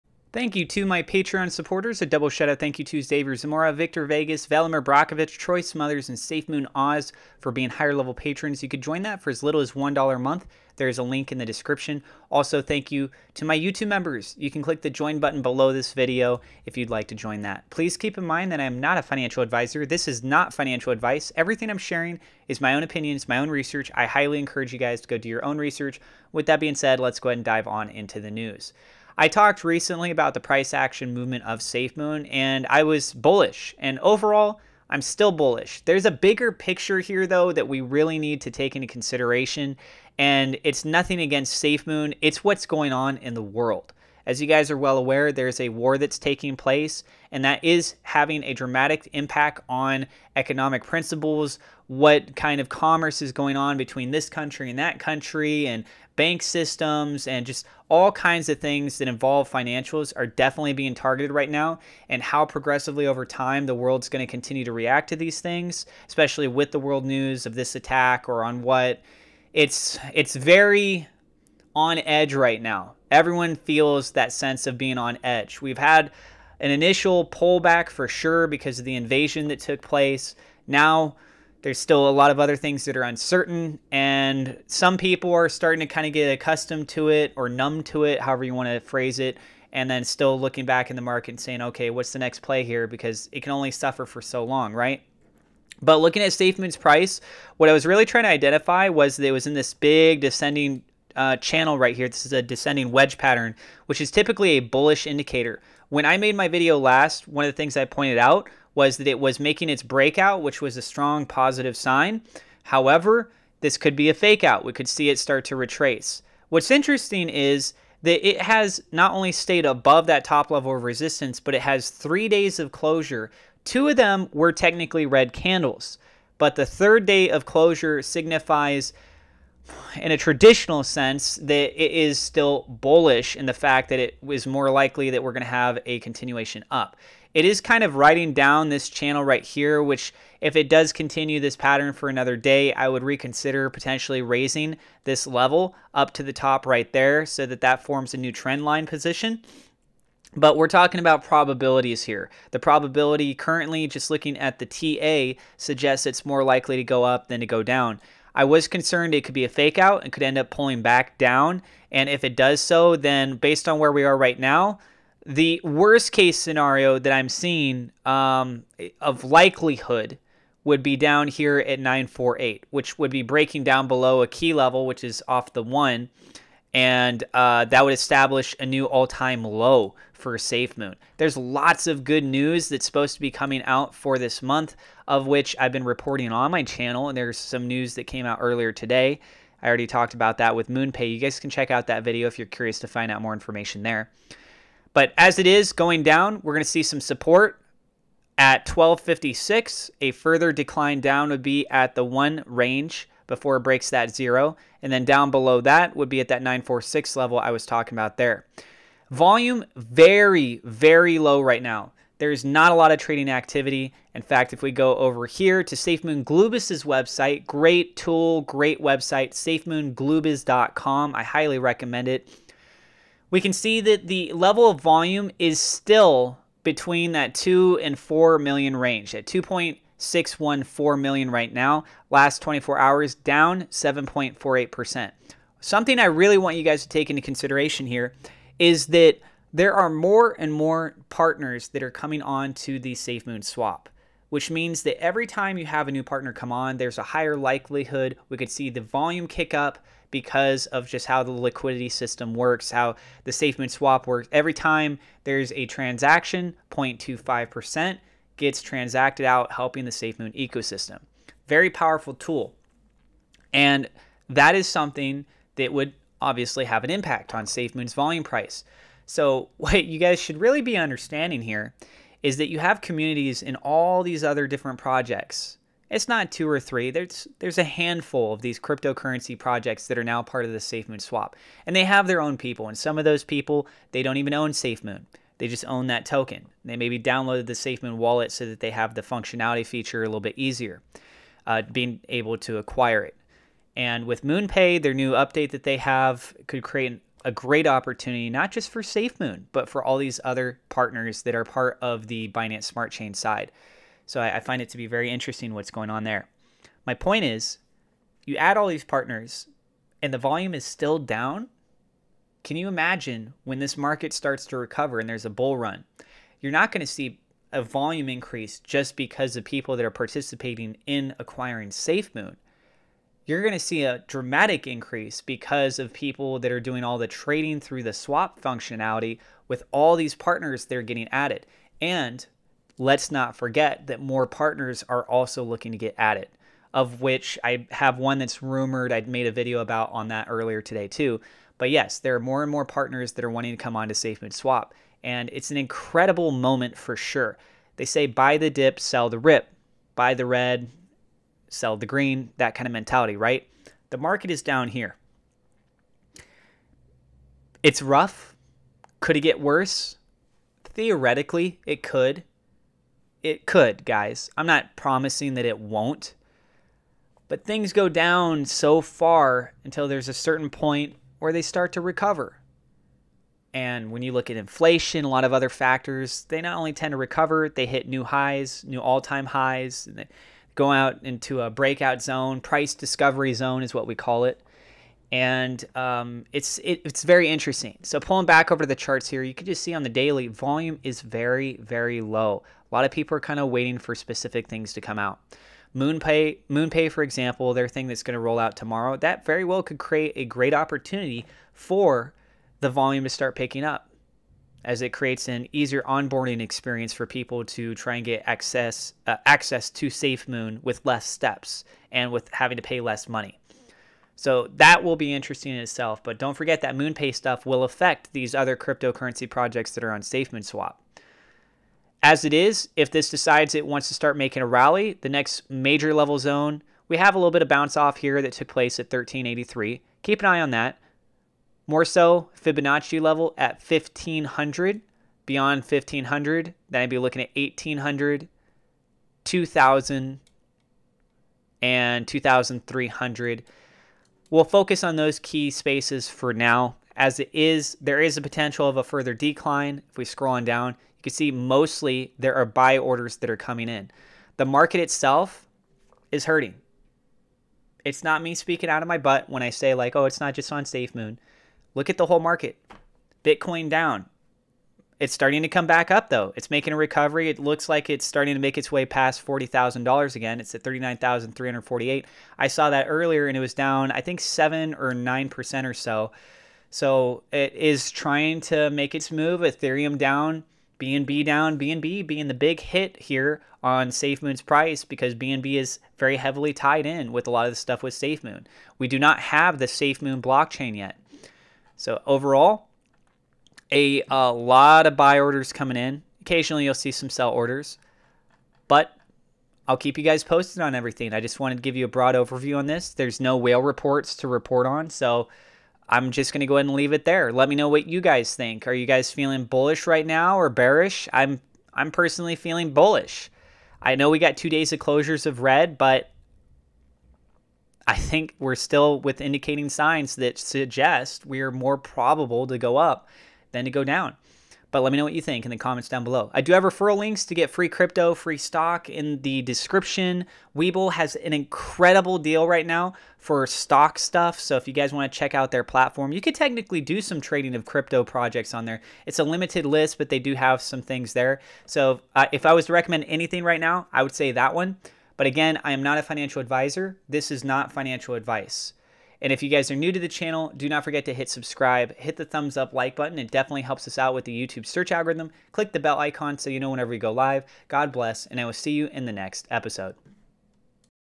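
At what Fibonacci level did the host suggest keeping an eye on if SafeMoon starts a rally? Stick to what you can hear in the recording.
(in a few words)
1500.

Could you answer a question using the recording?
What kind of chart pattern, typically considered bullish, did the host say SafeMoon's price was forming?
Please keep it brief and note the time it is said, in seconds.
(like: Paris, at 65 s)
Descending wedge, at 102 s.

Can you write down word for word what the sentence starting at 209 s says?
Volume very, very low right now.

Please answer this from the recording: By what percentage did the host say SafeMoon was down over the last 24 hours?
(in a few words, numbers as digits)
7.48%.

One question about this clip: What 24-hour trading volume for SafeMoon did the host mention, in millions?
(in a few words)
2.614 million.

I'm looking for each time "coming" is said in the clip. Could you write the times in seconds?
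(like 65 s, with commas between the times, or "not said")
183 s, 241 s, 453 s, 495 s.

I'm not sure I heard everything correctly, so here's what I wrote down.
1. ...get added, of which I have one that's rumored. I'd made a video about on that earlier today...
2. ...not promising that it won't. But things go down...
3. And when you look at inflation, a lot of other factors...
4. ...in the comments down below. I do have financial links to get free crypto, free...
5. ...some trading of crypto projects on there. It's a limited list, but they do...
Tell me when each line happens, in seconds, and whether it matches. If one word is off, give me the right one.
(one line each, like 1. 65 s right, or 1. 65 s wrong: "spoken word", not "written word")
1. 335 s right
2. 364 s right
3. 373 s right
4. 525 s wrong: "referral", not "financial"
5. 537 s right.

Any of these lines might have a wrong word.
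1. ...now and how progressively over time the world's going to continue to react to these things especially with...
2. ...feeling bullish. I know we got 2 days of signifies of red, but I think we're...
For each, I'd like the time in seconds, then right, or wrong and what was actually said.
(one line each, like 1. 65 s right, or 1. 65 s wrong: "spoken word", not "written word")
1. 61 s right
2. 512 s wrong: "closures", not "signifies".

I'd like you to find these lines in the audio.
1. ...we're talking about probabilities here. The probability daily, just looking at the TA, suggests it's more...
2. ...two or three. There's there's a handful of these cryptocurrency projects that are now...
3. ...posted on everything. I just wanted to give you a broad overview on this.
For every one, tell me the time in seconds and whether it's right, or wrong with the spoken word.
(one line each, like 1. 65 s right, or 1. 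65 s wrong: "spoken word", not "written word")
1. 150 s wrong: "currently", not "daily"
2. 276 s right
3. 500 s right.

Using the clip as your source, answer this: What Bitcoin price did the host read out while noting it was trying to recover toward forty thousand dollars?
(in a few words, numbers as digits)
$39,348.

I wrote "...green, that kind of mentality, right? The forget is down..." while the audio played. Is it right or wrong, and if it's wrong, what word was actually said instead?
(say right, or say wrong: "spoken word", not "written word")
wrong: "market", not "forget".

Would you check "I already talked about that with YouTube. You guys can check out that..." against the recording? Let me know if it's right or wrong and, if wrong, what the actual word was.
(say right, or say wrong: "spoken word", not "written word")
wrong: "MoonPay", not "YouTube".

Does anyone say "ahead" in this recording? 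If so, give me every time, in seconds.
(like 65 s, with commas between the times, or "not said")
27 s, 506 s.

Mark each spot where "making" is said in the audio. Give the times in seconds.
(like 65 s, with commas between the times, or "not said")
109 s, 424 s, 466 s.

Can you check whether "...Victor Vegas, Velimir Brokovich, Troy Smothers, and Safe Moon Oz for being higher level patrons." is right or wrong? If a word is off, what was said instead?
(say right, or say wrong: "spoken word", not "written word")
right.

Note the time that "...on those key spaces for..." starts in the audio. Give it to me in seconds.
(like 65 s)
444 s.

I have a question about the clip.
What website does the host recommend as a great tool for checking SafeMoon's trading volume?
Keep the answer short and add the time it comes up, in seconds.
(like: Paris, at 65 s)
safemoonglubis.com, at 219 s.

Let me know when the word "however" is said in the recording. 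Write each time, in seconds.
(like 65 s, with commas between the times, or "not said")
88 s, 112 s.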